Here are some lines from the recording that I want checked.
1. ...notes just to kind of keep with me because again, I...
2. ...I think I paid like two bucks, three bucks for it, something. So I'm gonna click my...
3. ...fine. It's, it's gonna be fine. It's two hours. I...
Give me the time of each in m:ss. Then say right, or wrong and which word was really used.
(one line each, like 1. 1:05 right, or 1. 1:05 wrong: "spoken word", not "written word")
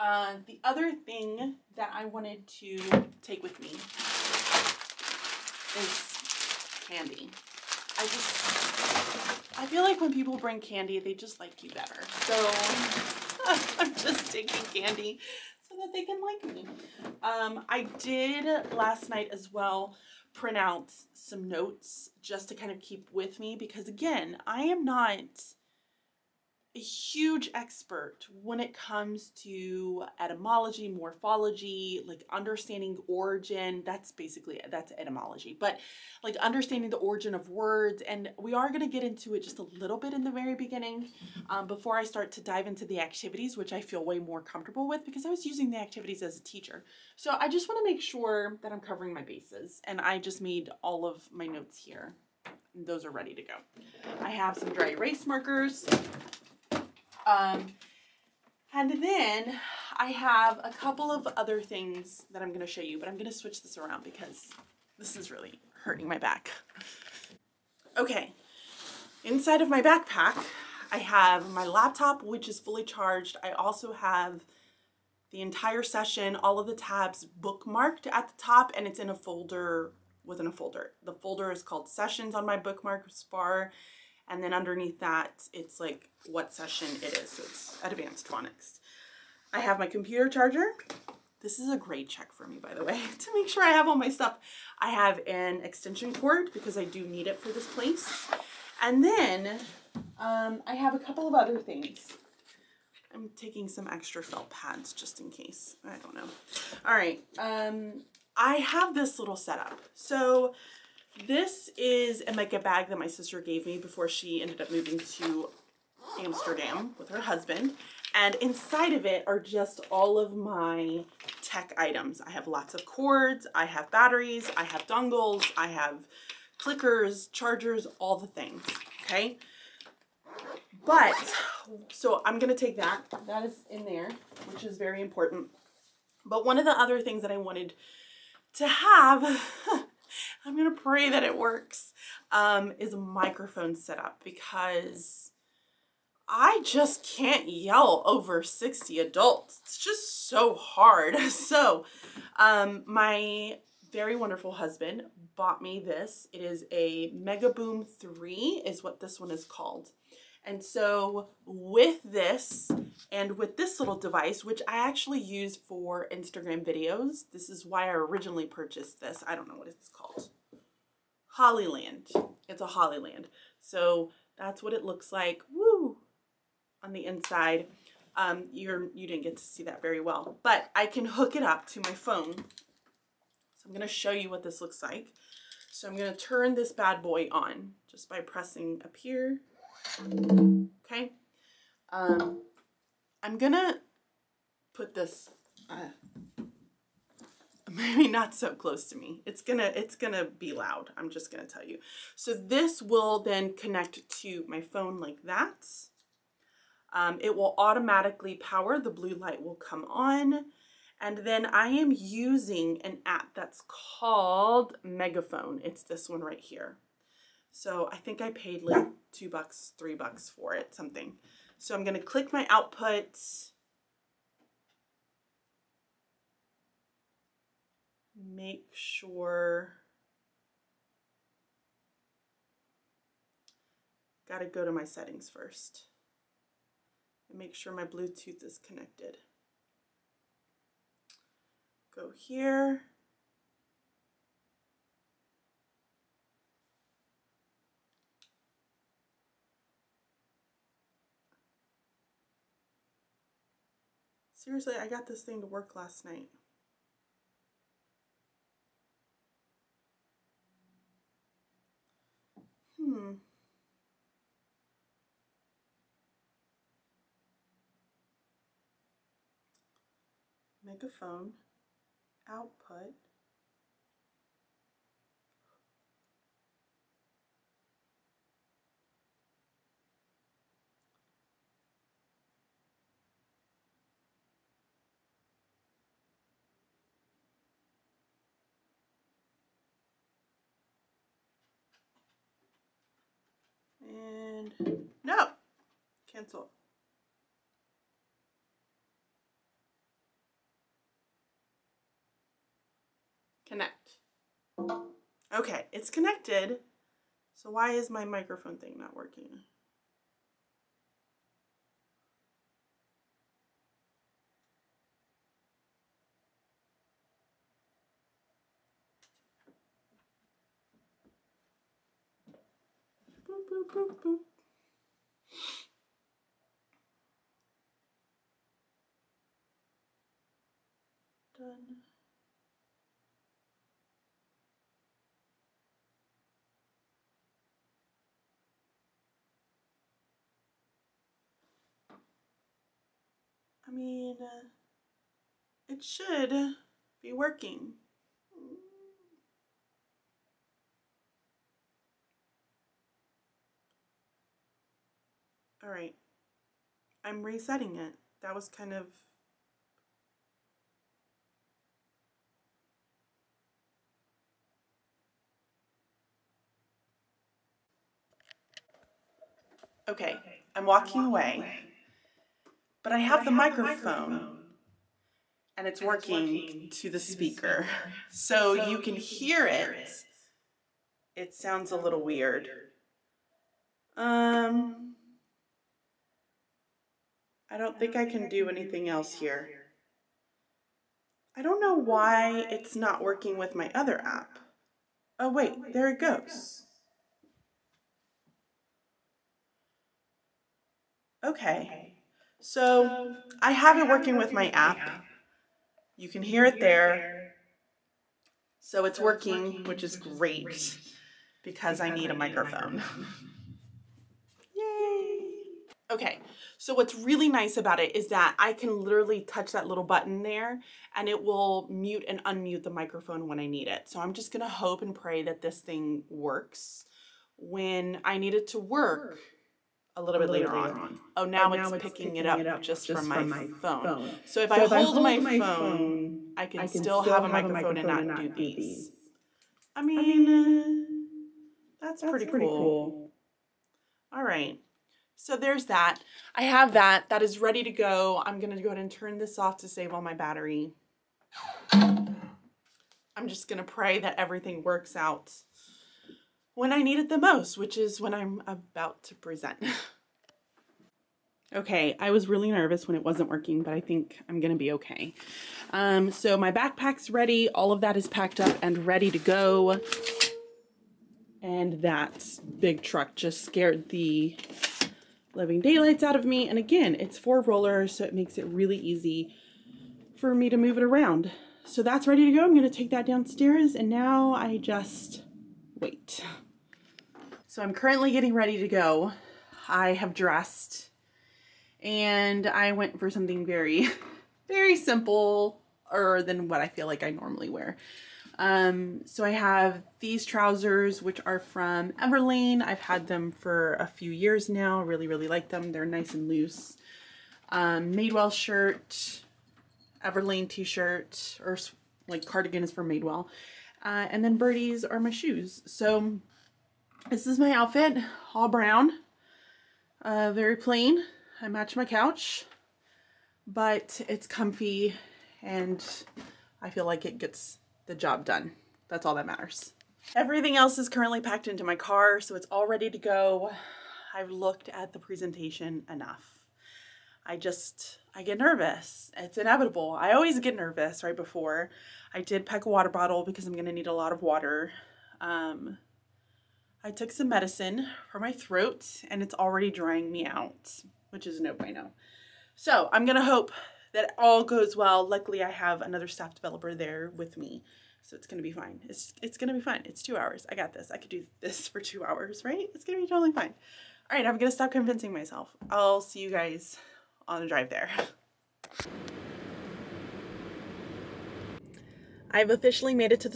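1. 0:21 right
2. 3:37 right
3. 9:18 right.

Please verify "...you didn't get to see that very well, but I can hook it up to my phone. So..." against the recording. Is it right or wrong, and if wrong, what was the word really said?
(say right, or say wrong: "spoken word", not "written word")
right.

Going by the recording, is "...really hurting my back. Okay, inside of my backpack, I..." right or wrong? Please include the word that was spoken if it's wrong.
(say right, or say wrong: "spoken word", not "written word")
right.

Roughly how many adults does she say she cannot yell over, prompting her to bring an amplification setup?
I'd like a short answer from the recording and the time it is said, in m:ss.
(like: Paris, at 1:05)
60, at 2:28.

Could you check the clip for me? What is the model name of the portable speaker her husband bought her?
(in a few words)
Megaboom 3.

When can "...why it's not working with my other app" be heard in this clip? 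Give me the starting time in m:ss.
6:31.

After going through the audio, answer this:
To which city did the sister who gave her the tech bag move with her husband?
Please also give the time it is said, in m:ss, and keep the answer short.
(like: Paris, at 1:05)
Amsterdam, at 1:56.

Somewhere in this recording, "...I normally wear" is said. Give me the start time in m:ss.
8:17.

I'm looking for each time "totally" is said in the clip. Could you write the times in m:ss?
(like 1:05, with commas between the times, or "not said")
9:23.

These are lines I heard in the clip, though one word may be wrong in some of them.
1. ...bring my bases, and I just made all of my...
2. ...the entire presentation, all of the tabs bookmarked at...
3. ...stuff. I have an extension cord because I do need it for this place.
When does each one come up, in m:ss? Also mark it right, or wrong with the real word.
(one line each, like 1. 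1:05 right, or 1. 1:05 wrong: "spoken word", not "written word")
1. 0:48 wrong: "covering", not "bring"
2. 1:15 wrong: "session", not "presentation"
3. 1:34 right.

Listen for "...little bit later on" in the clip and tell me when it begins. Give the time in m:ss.
7:10.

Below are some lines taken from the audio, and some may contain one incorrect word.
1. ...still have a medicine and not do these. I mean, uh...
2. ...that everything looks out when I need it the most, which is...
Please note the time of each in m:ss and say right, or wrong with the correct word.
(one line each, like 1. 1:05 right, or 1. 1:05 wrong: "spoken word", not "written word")
1. 7:16 wrong: "microphone", not "medicine"
2. 7:34 wrong: "works", not "looks".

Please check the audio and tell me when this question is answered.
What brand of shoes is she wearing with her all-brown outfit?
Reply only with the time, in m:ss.
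8:34.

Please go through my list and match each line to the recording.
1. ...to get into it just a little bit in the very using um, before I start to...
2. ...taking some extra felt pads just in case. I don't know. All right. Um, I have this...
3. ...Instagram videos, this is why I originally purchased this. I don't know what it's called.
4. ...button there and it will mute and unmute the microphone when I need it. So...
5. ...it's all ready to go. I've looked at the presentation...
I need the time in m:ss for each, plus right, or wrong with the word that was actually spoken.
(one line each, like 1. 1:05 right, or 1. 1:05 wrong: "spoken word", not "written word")
1. 0:38 wrong: "beginning", not "using"
2. 1:43 right
3. 2:46 right
4. 6:59 right
5. 8:52 right.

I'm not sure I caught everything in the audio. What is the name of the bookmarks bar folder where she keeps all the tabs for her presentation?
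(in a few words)
Sessions.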